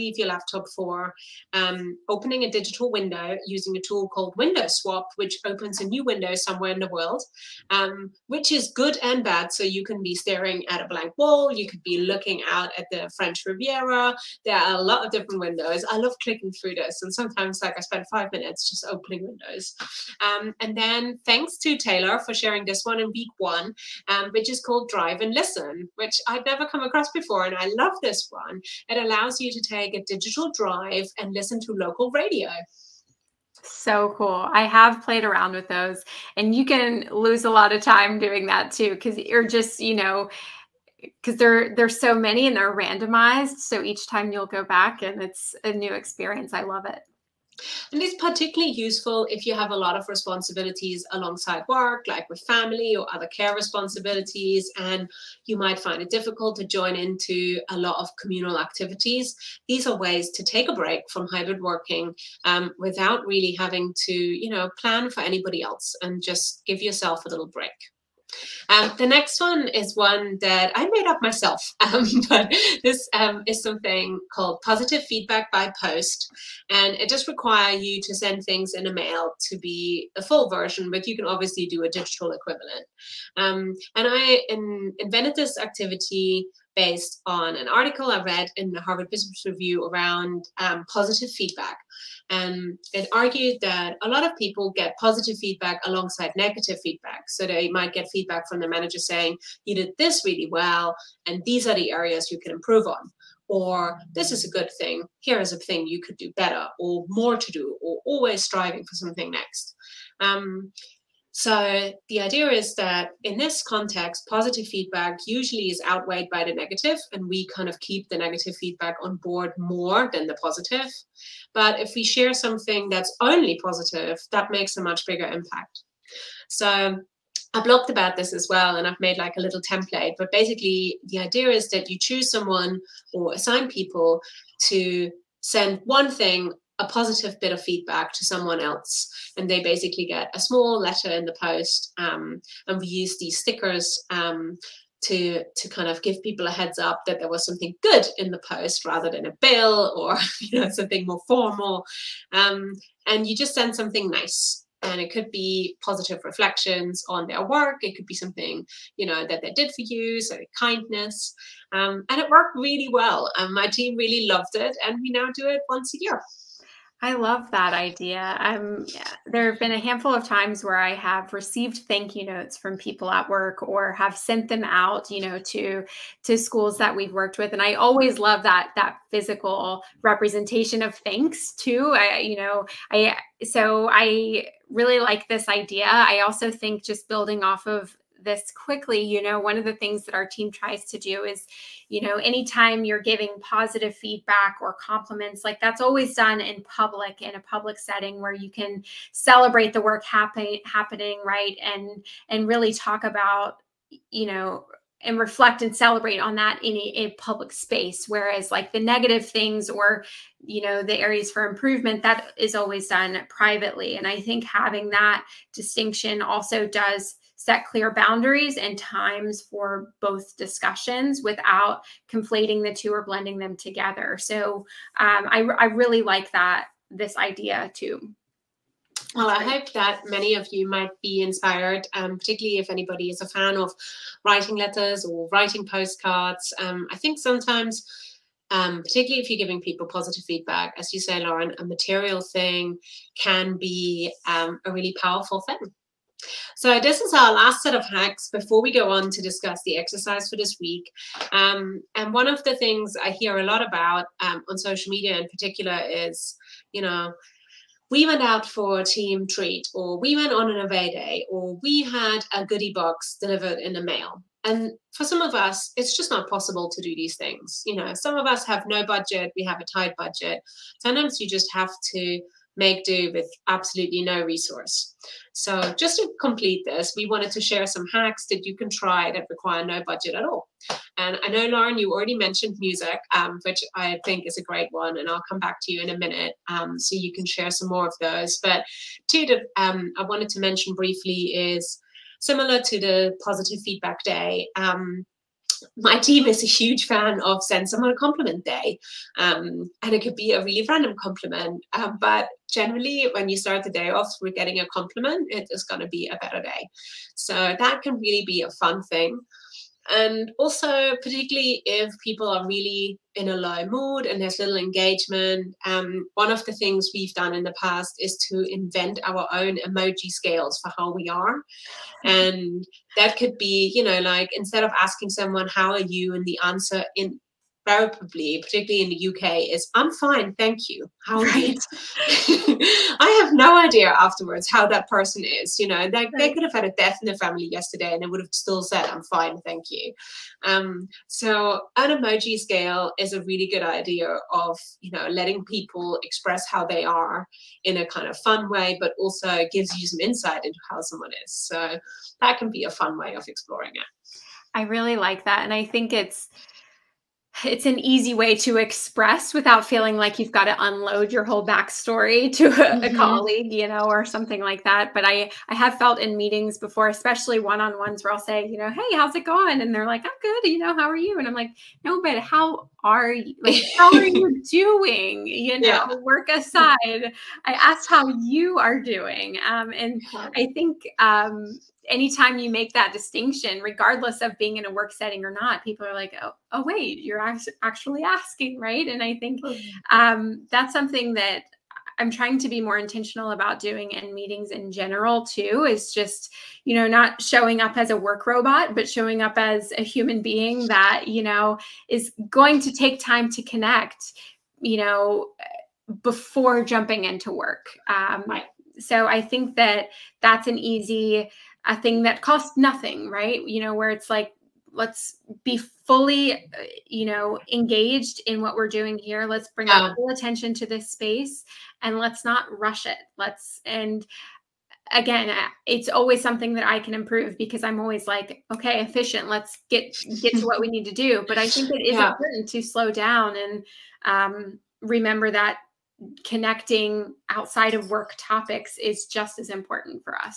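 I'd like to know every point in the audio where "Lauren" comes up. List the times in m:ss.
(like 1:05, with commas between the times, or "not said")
4:01, 4:41.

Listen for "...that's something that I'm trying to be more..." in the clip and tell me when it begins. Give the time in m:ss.
6:30.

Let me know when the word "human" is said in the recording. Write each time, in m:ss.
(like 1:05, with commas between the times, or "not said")
6:39.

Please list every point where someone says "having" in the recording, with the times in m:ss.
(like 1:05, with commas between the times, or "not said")
1:03, 3:34.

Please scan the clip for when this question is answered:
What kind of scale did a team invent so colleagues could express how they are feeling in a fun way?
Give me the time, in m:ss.
5:19.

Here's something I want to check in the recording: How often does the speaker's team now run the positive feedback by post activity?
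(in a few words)
once a year.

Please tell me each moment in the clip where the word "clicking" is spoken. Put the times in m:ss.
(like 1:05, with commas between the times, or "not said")
0:16.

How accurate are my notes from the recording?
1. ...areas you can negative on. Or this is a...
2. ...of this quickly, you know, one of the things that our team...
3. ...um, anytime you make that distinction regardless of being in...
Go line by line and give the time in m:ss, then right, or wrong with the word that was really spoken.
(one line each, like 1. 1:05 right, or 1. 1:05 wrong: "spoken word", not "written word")
1. 1:41 wrong: "improve", not "negative"
2. 3:07 right
3. 6:20 right.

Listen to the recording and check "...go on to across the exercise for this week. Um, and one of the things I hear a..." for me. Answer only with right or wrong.
wrong.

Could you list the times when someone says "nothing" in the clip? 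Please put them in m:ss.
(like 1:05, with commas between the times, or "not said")
6:52.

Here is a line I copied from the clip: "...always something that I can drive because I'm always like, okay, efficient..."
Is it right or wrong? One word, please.
wrong.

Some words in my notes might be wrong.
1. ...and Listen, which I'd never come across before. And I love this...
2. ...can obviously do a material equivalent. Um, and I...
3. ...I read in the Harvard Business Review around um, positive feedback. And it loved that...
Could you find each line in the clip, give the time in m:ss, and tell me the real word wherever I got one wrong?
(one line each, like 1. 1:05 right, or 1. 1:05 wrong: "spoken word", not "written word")
1. 0:25 right
2. 1:21 wrong: "digital", not "material"
3. 1:28 wrong: "argued", not "loved".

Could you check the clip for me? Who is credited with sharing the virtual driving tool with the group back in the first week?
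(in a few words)
Taylor.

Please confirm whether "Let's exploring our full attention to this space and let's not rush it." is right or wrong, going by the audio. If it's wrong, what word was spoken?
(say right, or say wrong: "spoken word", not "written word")
wrong: "bring", not "exploring".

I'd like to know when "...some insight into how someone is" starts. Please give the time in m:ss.
5:49.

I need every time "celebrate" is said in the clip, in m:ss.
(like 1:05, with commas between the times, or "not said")
3:19, 3:25.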